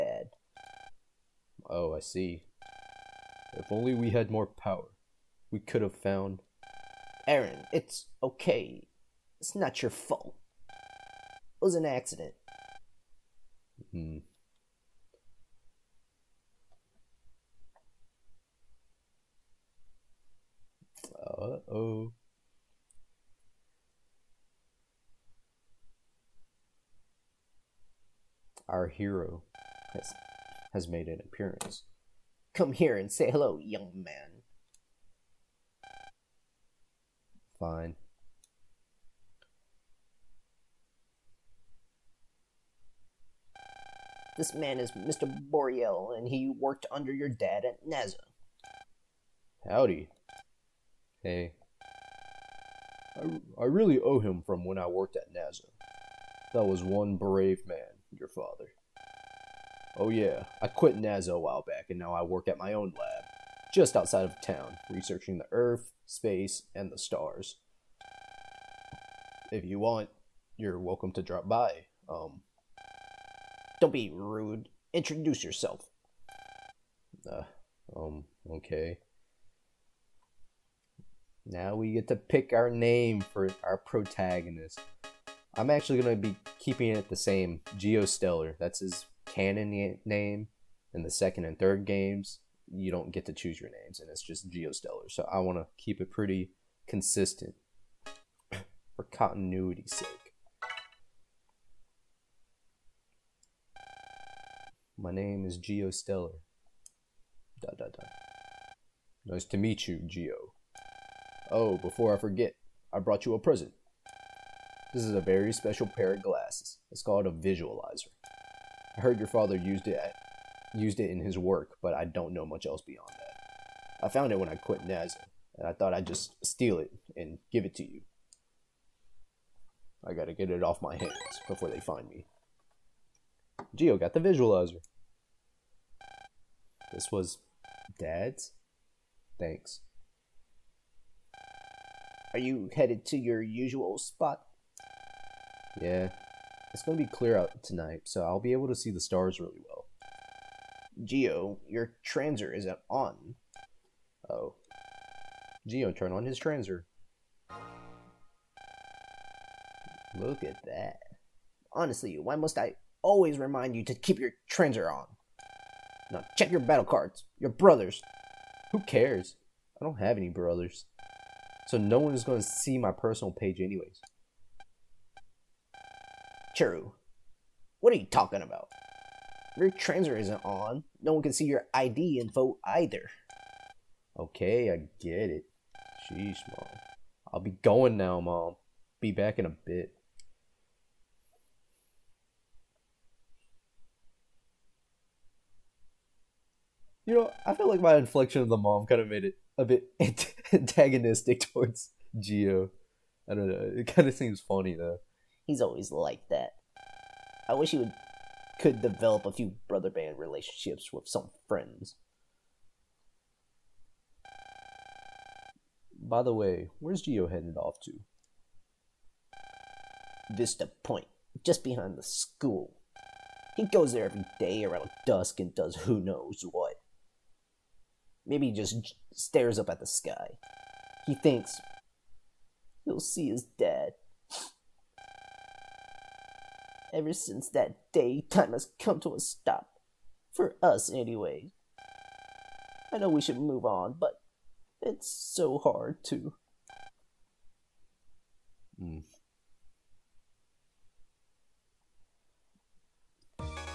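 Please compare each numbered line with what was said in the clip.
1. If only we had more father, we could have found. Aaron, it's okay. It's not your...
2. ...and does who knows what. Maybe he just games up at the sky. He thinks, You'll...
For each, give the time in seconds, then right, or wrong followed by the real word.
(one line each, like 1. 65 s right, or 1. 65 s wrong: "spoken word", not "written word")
1. 3 s wrong: "power", not "father"
2. 225 s wrong: "stares", not "games".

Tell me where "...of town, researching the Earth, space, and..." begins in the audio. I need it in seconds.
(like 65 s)
64 s.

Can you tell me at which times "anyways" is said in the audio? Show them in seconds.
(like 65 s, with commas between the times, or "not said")
173 s, 240 s.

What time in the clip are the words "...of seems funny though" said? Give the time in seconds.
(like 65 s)
204 s.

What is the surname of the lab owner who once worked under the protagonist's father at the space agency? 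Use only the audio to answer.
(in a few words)
Boreal.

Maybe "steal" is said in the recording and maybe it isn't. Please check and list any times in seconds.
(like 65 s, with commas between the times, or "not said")
126 s.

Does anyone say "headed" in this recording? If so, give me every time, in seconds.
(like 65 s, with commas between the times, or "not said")
142 s, 217 s.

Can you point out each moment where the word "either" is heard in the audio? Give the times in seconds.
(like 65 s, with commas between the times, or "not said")
182 s.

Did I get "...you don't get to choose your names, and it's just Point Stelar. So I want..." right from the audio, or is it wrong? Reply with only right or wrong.
wrong.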